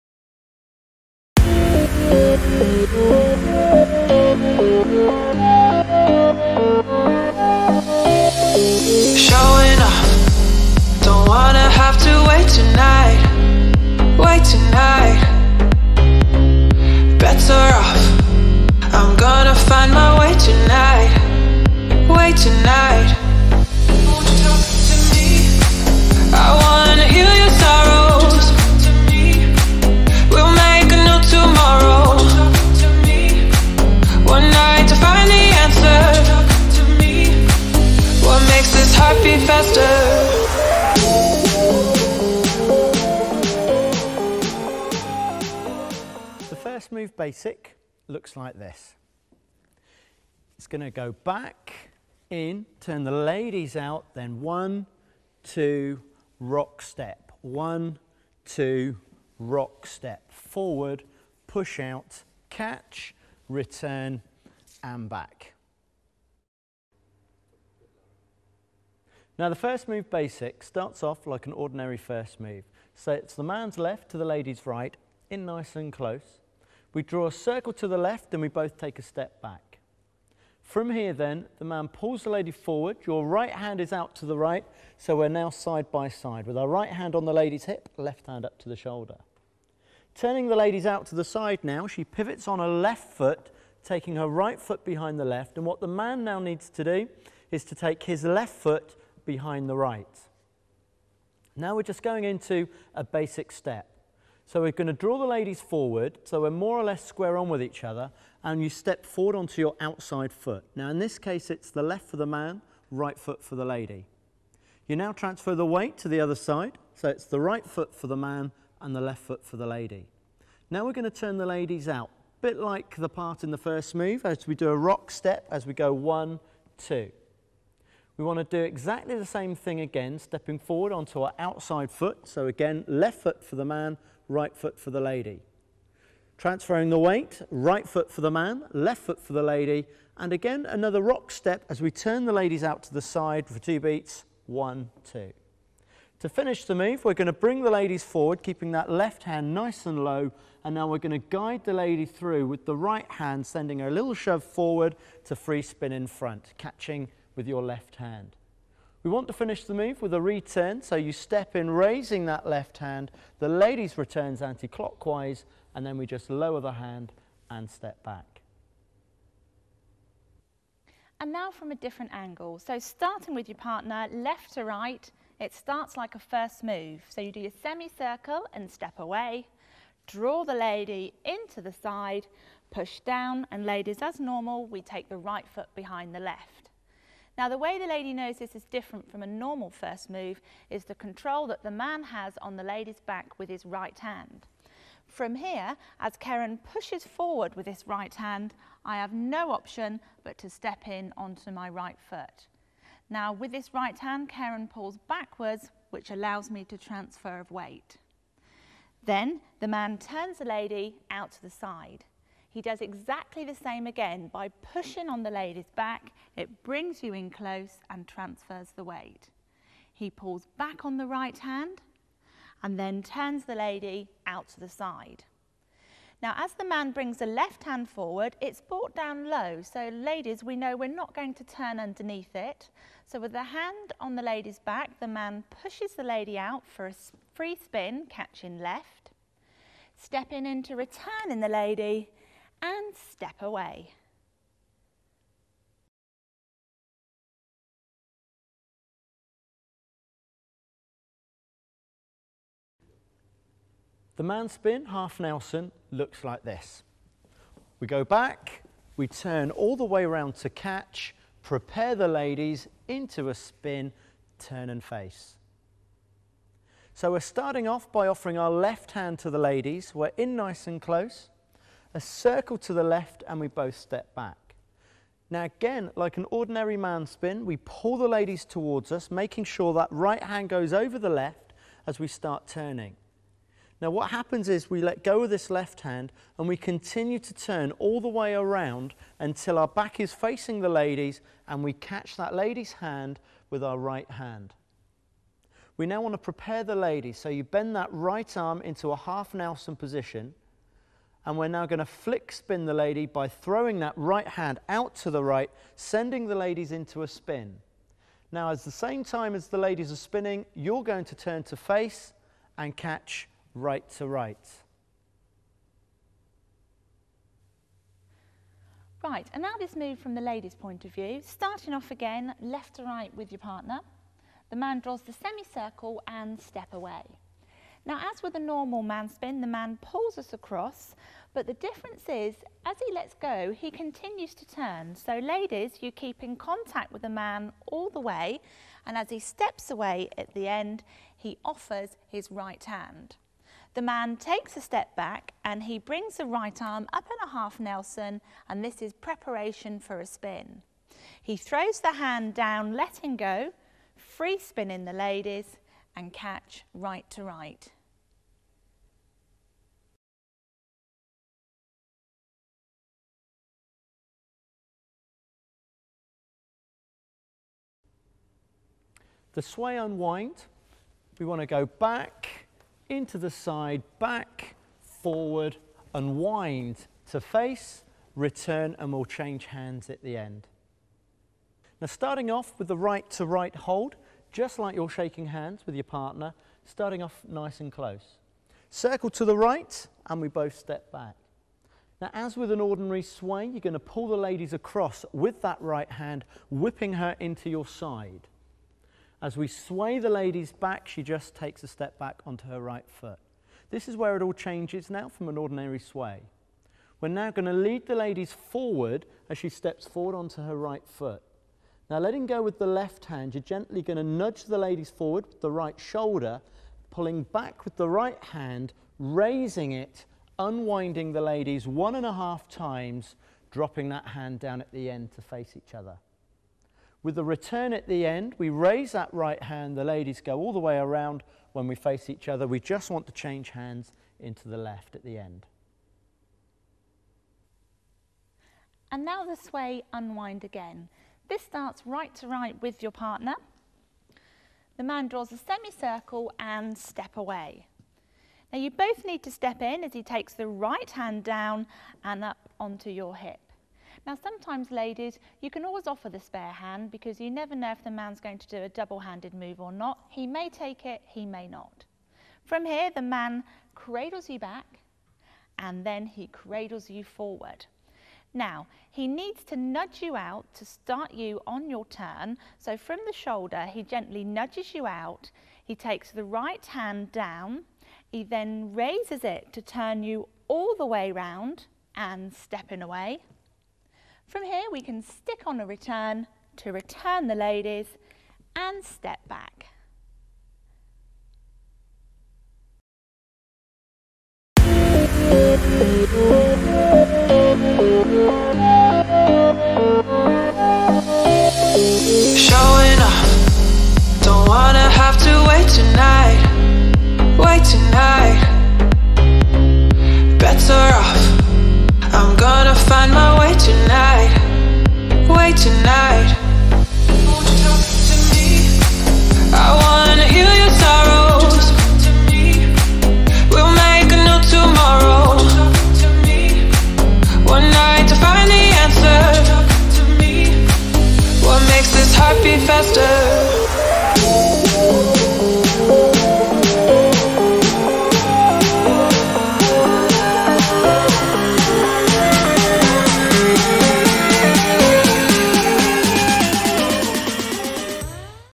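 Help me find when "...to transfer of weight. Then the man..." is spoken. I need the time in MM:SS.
03:26.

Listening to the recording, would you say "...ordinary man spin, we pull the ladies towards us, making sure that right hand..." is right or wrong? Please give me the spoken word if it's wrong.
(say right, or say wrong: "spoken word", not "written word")
right.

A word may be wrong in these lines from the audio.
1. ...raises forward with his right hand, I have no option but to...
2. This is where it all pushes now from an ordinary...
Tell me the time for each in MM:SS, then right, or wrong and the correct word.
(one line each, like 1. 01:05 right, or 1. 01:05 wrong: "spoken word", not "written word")
1. 03:16 wrong: "pushes", not "raises"
2. 06:43 wrong: "changes", not "pushes".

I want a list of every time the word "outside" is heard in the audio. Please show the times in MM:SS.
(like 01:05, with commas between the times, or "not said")
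01:49, 02:11.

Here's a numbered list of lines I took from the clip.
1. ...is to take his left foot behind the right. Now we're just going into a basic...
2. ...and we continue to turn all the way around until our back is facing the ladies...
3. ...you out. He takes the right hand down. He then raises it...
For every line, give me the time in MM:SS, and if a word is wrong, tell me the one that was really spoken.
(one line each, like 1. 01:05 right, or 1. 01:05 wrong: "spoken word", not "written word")
1. 01:37 right
2. 04:46 right
3. 07:54 right.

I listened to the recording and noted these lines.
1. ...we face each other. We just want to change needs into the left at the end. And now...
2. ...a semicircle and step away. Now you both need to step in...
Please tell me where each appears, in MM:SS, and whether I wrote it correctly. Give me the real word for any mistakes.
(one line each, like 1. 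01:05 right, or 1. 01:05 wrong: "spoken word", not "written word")
1. 07:11 wrong: "hands", not "needs"
2. 07:25 right.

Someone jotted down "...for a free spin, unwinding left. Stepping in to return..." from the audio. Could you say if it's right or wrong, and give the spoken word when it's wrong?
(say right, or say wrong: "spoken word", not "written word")
wrong: "catching", not "unwinding".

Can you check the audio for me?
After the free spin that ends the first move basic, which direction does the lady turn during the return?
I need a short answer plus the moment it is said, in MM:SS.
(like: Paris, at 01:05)
Anti-clockwise, at 02:44.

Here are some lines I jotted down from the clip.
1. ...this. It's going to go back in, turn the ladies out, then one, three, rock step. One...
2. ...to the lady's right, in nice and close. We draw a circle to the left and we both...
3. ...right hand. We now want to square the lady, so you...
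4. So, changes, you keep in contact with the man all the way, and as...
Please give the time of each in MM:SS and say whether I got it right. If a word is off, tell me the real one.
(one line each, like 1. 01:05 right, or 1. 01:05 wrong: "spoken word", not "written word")
1. 00:48 wrong: "two", not "three"
2. 01:14 right
3. 04:53 wrong: "prepare", not "square"
4. 05:34 wrong: "ladies", not "changes".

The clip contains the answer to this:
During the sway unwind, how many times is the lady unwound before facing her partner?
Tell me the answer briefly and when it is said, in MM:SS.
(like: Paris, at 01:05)
1.5, at 07:01.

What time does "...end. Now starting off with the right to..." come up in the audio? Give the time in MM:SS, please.
06:20.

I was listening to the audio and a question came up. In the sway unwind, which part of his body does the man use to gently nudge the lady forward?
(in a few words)
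Right shoulder.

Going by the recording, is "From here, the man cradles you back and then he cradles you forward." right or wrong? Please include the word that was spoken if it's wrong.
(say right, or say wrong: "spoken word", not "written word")
right.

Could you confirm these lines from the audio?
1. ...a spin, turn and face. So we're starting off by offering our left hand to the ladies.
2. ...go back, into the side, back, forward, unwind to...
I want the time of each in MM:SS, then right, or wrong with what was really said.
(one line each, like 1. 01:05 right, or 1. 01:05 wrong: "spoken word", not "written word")
1. 04:23 right
2. 06:11 right.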